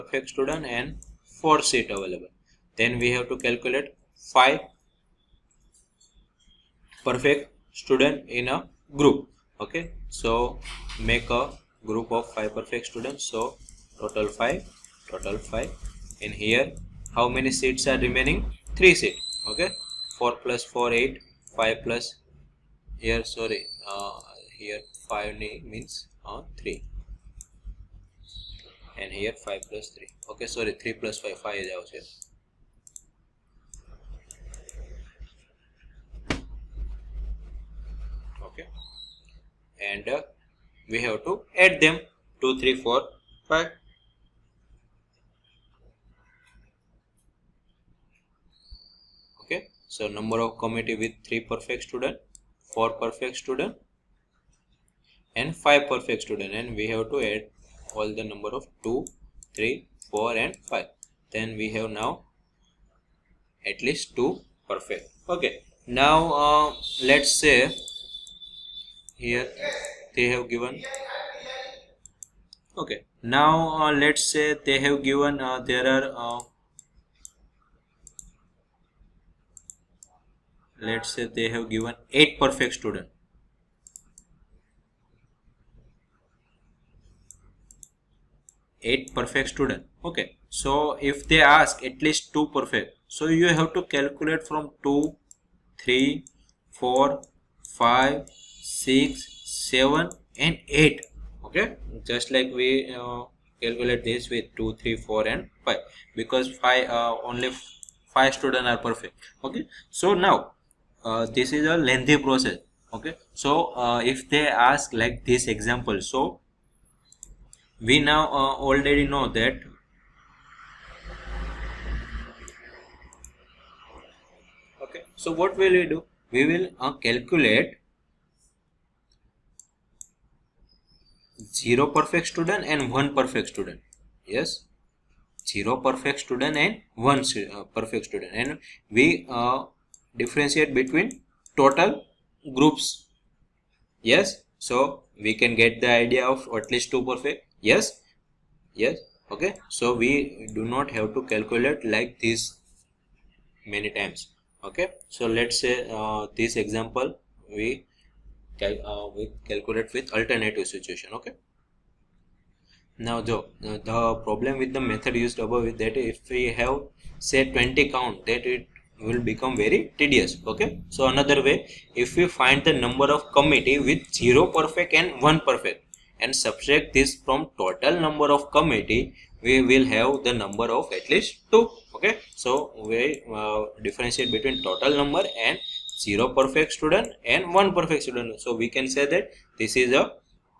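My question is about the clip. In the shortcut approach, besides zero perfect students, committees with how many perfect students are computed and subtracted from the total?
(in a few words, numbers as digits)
1.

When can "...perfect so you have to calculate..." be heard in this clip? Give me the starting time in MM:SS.
01:32.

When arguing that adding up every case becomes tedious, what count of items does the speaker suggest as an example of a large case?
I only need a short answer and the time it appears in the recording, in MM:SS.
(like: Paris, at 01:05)
20, at 02:47.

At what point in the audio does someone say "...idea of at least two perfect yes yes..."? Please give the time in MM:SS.
02:25.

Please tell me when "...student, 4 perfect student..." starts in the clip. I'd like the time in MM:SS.
00:51.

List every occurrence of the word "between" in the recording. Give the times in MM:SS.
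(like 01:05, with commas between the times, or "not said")
02:20, 03:04.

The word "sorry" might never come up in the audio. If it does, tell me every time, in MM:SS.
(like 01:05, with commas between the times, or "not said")
00:23, 00:30.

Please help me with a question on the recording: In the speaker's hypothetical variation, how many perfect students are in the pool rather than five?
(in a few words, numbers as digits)
8.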